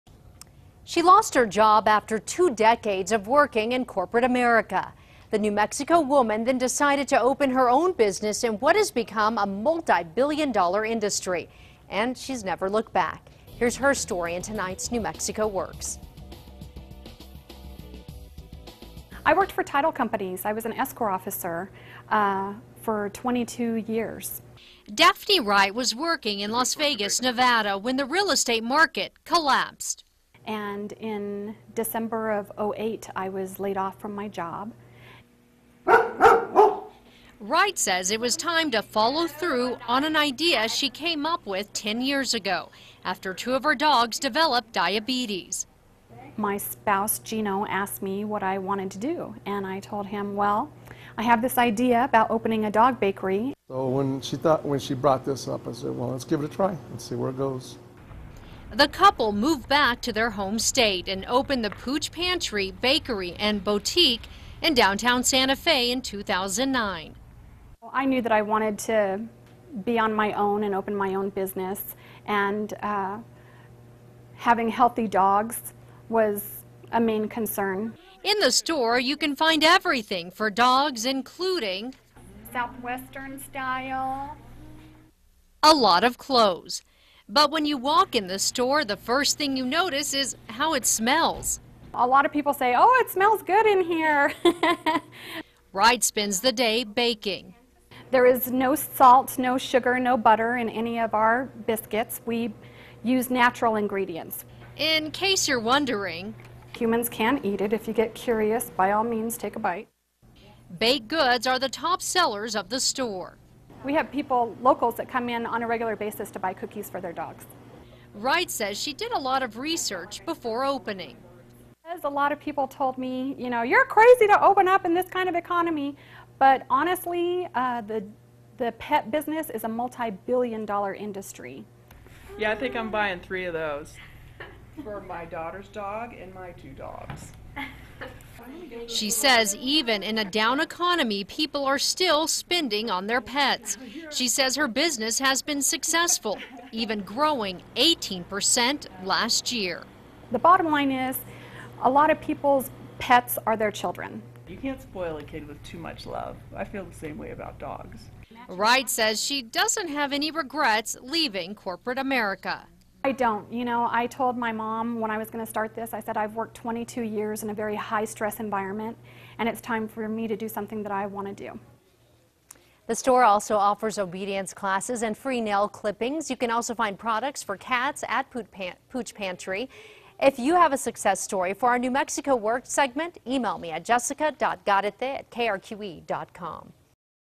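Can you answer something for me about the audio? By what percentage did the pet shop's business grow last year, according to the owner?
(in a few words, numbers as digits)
18%.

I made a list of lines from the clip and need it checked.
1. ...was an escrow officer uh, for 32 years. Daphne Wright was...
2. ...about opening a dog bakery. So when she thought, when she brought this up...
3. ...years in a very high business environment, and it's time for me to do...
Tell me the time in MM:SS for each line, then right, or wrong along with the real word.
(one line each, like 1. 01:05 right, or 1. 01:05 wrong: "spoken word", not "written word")
1. 00:20 wrong: "22", not "32"
2. 00:52 right
3. 02:47 wrong: "stress", not "business".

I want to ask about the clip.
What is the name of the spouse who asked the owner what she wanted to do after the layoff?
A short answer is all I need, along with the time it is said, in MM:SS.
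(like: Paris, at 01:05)
Gino, at 00:47.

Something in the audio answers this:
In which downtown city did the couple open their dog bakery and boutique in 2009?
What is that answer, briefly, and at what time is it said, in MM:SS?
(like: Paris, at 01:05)
Santa Fe, at 01:05.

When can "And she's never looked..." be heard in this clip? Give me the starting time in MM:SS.
00:11.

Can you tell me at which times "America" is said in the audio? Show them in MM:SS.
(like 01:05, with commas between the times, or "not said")
00:04, 02:41.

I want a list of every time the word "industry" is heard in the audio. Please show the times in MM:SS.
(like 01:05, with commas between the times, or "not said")
00:10, 02:10.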